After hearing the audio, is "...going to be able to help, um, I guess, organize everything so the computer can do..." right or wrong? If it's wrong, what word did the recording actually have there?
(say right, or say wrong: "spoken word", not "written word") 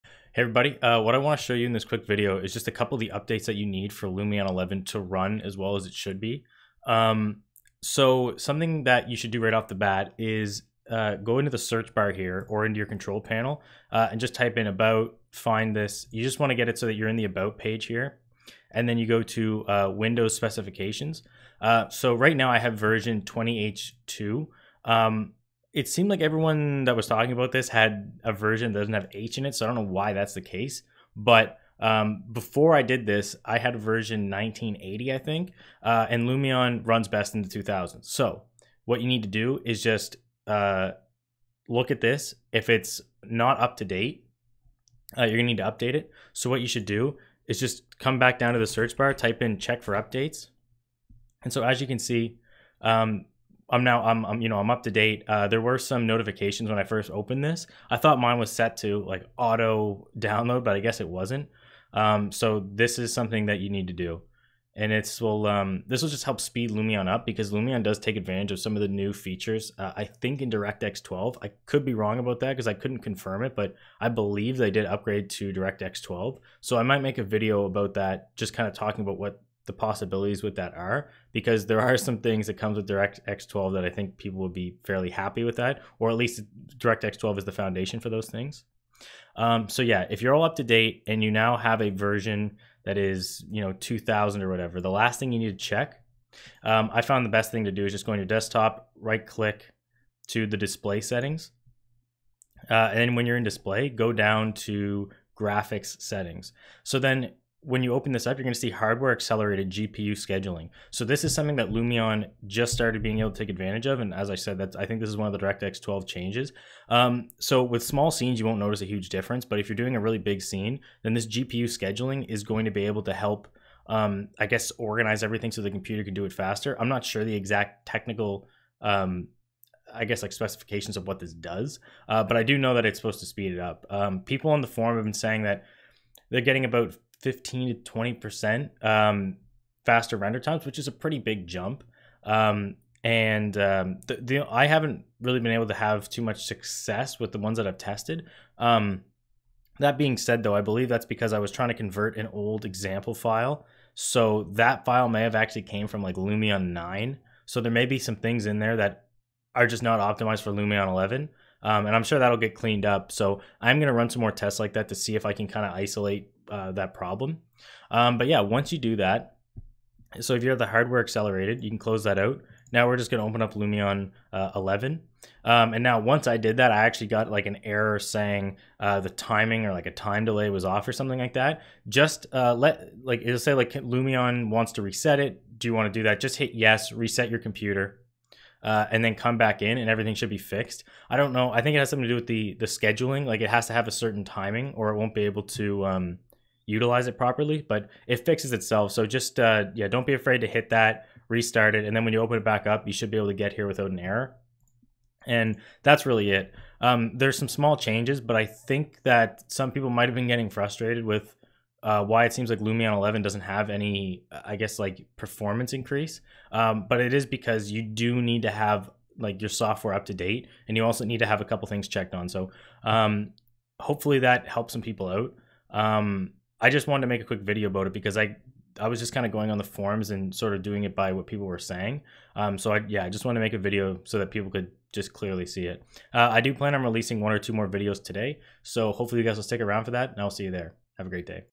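right.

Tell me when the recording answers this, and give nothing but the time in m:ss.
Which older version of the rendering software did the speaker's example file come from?
2:36.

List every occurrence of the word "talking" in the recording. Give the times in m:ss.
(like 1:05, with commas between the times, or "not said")
0:27, 1:18.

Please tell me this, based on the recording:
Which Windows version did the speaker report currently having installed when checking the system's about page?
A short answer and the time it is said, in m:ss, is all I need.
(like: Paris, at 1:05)
20H2, at 0:23.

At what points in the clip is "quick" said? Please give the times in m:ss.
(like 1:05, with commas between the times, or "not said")
0:01, 3:47.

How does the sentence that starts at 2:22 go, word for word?
Um, and um, the, the, I haven't really been able to have too much success with the ones that I've tested.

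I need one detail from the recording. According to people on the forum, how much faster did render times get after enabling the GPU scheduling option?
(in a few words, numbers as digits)
15 to 20%.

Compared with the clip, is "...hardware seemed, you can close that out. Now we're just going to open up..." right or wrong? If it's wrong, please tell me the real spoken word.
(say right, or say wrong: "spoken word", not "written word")
wrong: "accelerated", not "seemed".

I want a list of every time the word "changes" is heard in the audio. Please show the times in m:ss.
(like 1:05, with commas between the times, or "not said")
1:56, 3:27.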